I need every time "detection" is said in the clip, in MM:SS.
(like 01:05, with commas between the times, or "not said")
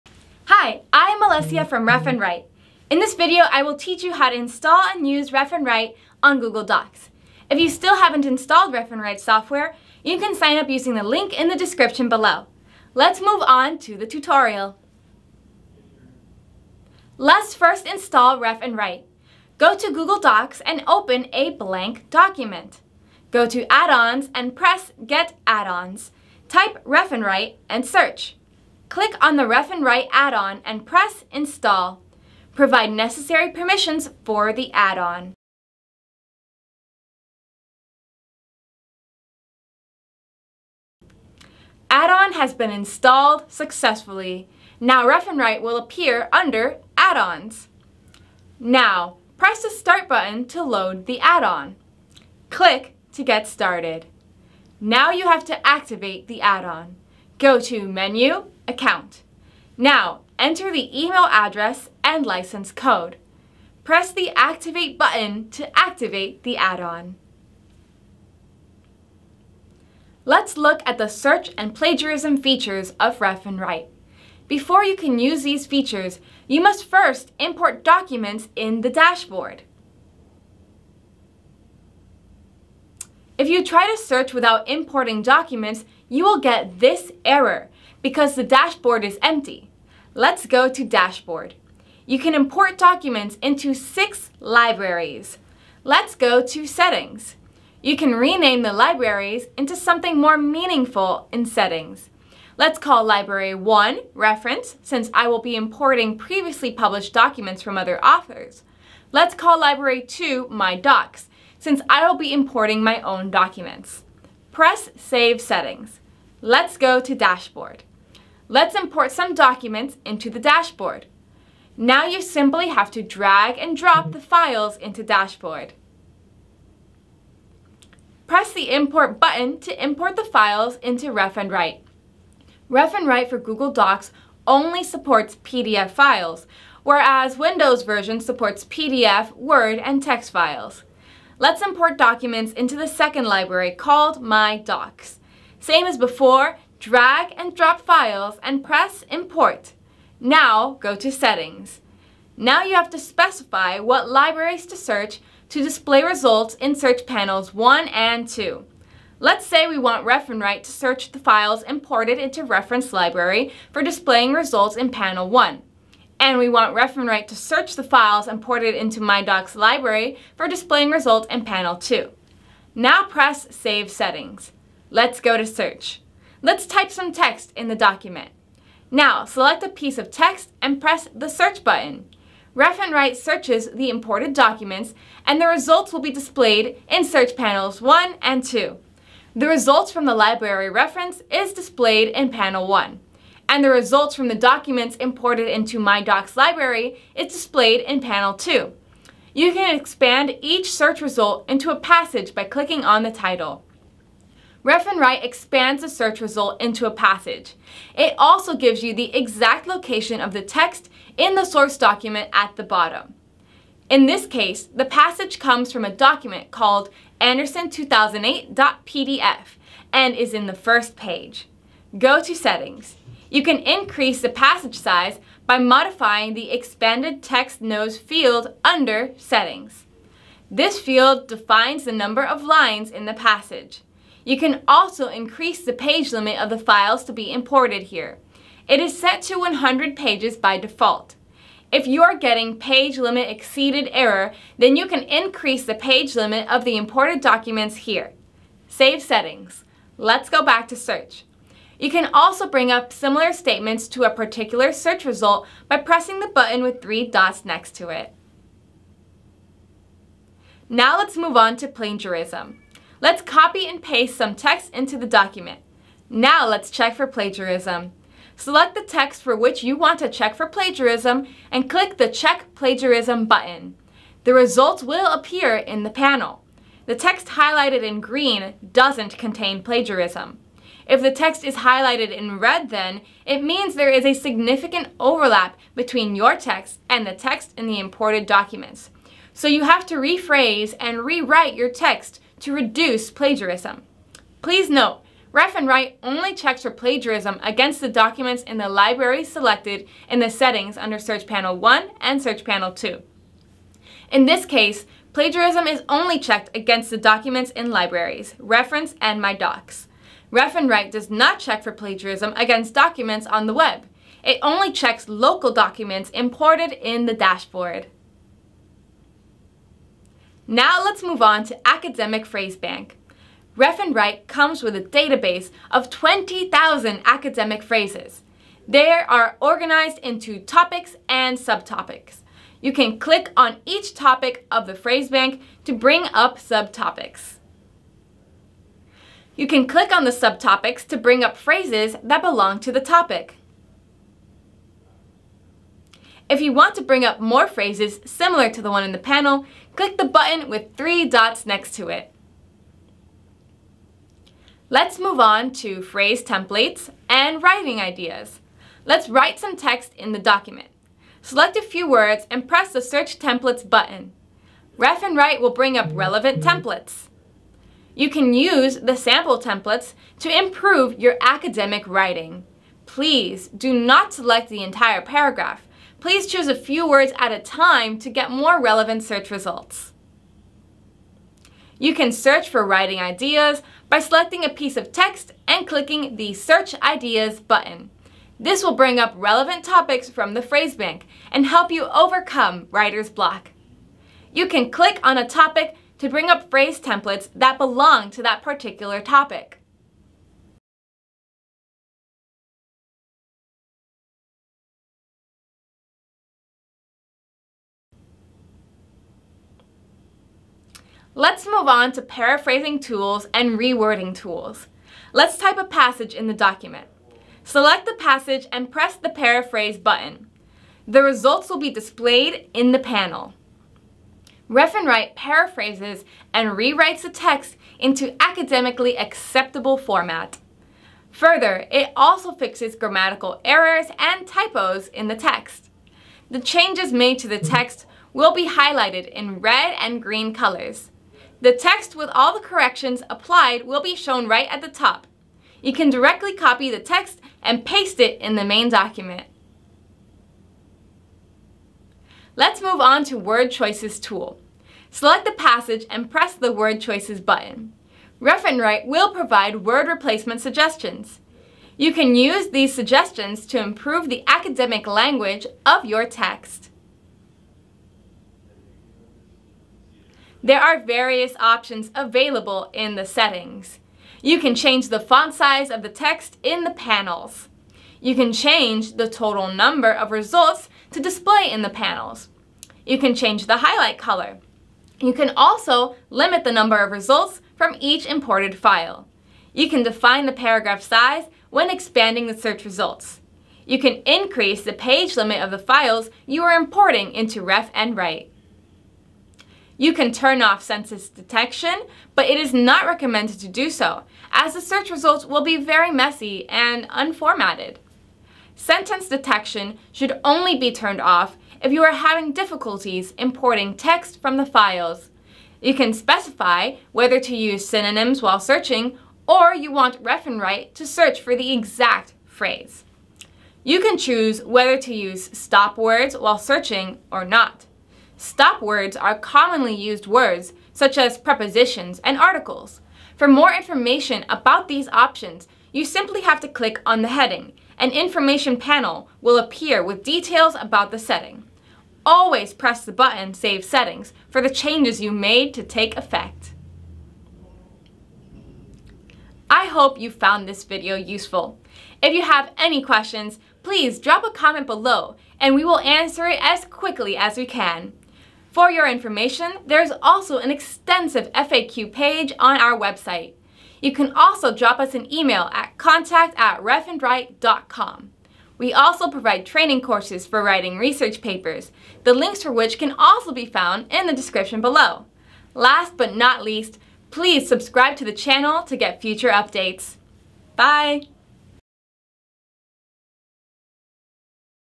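08:21, 08:29.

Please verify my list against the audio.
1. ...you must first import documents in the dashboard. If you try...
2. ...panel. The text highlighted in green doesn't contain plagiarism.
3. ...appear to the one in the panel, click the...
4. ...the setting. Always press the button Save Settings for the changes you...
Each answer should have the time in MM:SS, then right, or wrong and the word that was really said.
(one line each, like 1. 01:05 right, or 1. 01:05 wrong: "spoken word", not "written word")
1. 01:16 right
2. 04:35 right
3. 05:48 wrong: "similar", not "appear"
4. 09:00 right.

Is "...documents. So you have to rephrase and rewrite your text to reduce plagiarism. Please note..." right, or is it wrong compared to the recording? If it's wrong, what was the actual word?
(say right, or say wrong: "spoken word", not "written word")
right.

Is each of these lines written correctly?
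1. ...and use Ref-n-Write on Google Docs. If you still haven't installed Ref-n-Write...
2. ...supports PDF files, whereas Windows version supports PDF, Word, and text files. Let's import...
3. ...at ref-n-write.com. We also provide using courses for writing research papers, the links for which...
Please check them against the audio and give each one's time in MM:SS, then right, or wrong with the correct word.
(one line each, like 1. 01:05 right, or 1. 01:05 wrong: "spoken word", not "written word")
1. 00:04 right
2. 02:14 right
3. 09:26 wrong: "training", not "using".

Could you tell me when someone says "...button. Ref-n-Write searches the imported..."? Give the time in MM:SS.
03:01.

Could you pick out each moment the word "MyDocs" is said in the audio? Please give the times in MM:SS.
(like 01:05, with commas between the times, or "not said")
02:49, 03:15.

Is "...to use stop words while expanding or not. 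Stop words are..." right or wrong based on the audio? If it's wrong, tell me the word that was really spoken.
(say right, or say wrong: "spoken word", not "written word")
wrong: "searching", not "expanding".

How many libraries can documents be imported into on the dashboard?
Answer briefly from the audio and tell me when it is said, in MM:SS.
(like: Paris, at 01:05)
6, at 01:33.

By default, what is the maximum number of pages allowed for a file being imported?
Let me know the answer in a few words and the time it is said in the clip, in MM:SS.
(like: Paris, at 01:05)
100, at 03:59.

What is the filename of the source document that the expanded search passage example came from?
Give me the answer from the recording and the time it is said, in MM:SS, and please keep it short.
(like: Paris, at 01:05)
anderson2008.pdf, at 03:37.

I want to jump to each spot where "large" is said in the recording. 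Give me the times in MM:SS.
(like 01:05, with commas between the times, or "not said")
not said.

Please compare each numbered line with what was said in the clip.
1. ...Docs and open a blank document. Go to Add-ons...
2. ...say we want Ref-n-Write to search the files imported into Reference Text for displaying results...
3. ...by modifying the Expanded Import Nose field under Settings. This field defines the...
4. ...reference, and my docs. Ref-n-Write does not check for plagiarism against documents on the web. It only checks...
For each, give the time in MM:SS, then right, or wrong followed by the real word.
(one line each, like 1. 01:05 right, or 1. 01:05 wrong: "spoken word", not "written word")
1. 00:20 right
2. 02:39 wrong: "Library", not "Text"
3. 03:45 wrong: "Text", not "Import"
4. 05:08 right.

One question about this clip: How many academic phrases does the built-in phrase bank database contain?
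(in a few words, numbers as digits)
20,000.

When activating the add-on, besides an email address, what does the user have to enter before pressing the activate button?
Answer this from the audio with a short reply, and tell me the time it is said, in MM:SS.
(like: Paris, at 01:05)
License code, at 01:02.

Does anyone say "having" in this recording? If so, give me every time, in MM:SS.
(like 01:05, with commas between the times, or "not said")
08:31.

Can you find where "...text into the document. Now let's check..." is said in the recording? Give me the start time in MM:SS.
04:24.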